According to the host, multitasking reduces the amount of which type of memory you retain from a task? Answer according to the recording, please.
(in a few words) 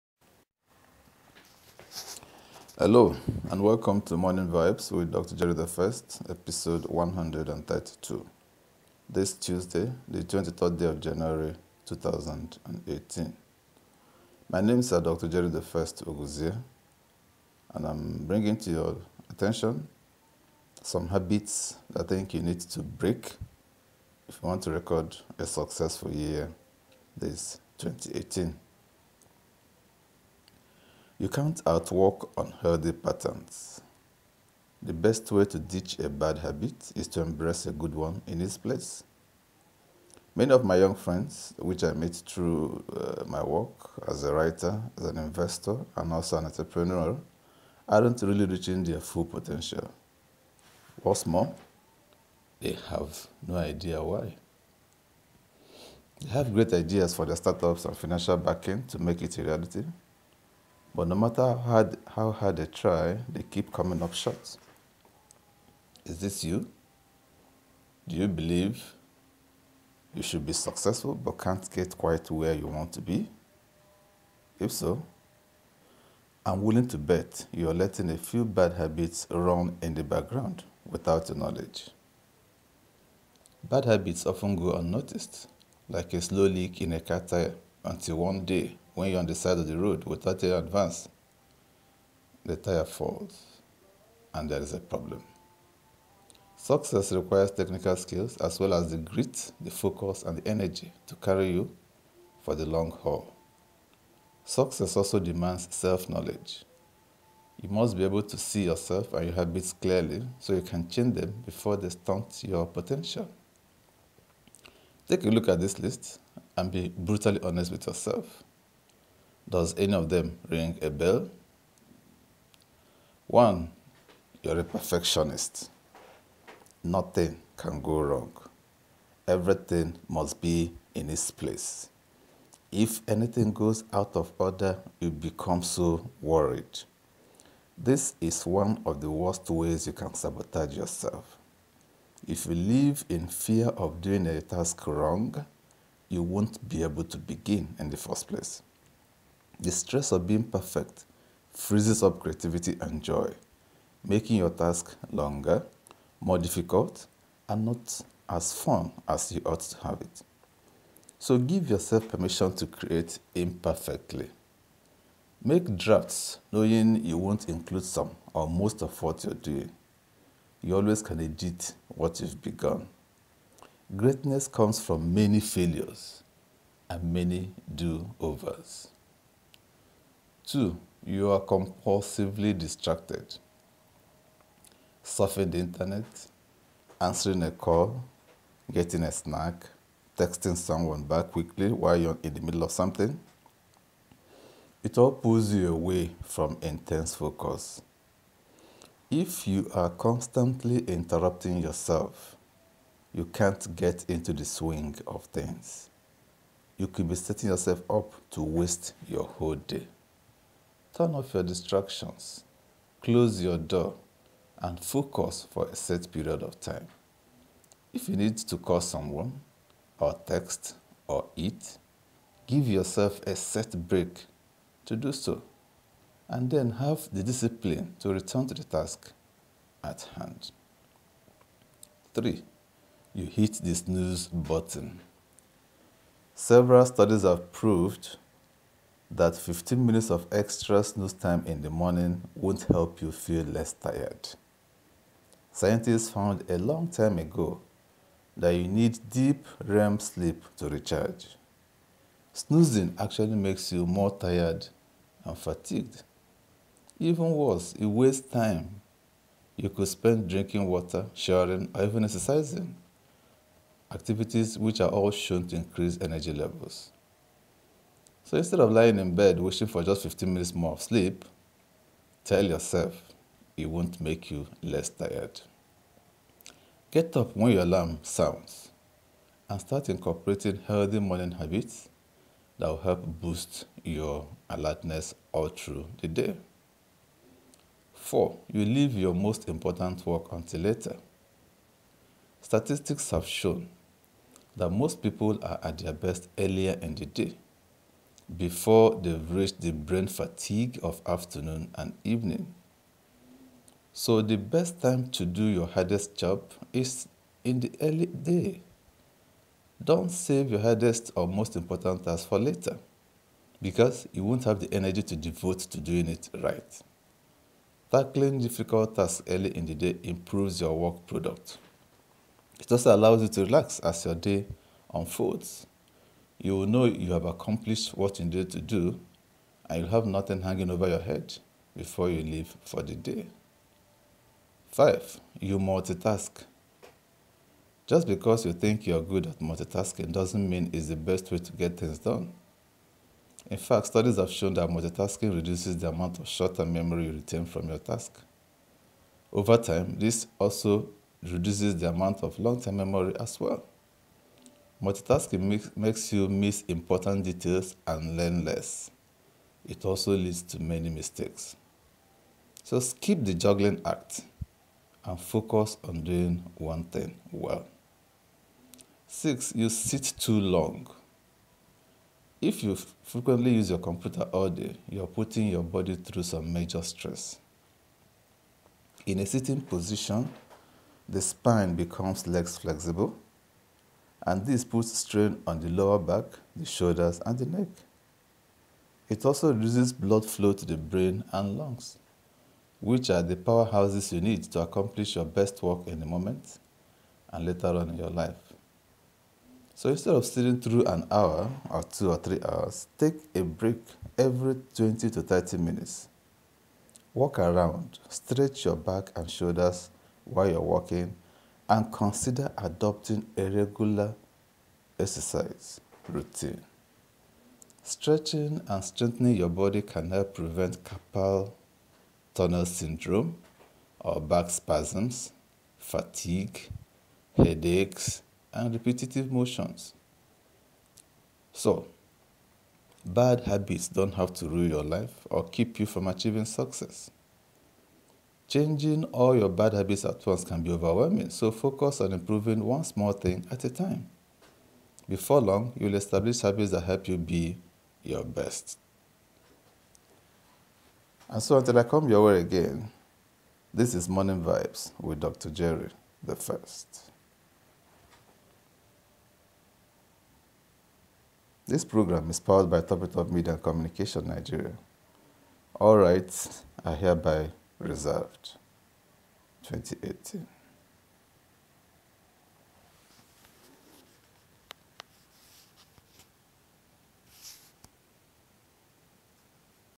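short term memory.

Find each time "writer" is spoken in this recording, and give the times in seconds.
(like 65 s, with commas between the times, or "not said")
44 s.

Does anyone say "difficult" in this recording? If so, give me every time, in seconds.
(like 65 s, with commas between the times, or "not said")
156 s, 318 s.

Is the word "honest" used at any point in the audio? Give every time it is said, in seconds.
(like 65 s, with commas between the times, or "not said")
117 s.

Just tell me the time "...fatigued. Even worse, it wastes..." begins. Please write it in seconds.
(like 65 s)
255 s.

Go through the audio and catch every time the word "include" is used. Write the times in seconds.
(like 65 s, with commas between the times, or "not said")
167 s.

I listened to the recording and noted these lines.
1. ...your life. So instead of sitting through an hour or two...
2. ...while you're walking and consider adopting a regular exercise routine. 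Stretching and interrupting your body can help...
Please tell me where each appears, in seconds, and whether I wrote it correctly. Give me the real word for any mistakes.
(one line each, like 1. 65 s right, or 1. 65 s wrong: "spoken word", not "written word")
1. 397 s right
2. 410 s wrong: "strengthening", not "interrupting".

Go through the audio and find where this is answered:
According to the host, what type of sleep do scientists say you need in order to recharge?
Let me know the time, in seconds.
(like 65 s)
249 s.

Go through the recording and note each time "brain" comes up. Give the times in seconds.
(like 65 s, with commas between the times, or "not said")
299 s, 390 s.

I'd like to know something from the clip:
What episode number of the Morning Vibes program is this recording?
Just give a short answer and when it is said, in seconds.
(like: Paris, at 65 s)
132, at 6 s.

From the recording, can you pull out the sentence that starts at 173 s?
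Greatness comes from many failures and many do overs.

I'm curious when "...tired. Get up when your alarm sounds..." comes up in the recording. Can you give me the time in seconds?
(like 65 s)
274 s.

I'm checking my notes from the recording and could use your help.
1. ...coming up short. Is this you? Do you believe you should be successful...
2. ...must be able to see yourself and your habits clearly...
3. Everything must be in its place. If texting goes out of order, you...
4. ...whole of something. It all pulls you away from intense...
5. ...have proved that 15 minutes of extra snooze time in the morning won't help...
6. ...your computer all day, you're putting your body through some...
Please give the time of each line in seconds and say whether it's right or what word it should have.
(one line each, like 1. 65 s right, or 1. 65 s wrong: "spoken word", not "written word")
1. 63 s right
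2. 107 s right
3. 129 s wrong: "anything", not "texting"
4. 192 s wrong: "middle", not "whole"
5. 237 s right
6. 373 s right.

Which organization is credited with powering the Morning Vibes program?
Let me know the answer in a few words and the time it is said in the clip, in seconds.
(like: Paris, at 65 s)
Top Top Media and Communication Nigeria, at 462 s.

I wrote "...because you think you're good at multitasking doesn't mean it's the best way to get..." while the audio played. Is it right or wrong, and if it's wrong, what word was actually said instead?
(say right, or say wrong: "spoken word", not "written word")
right.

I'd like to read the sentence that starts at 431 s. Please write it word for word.
So, bad habits don't have to rule your life or keep you from achieving success.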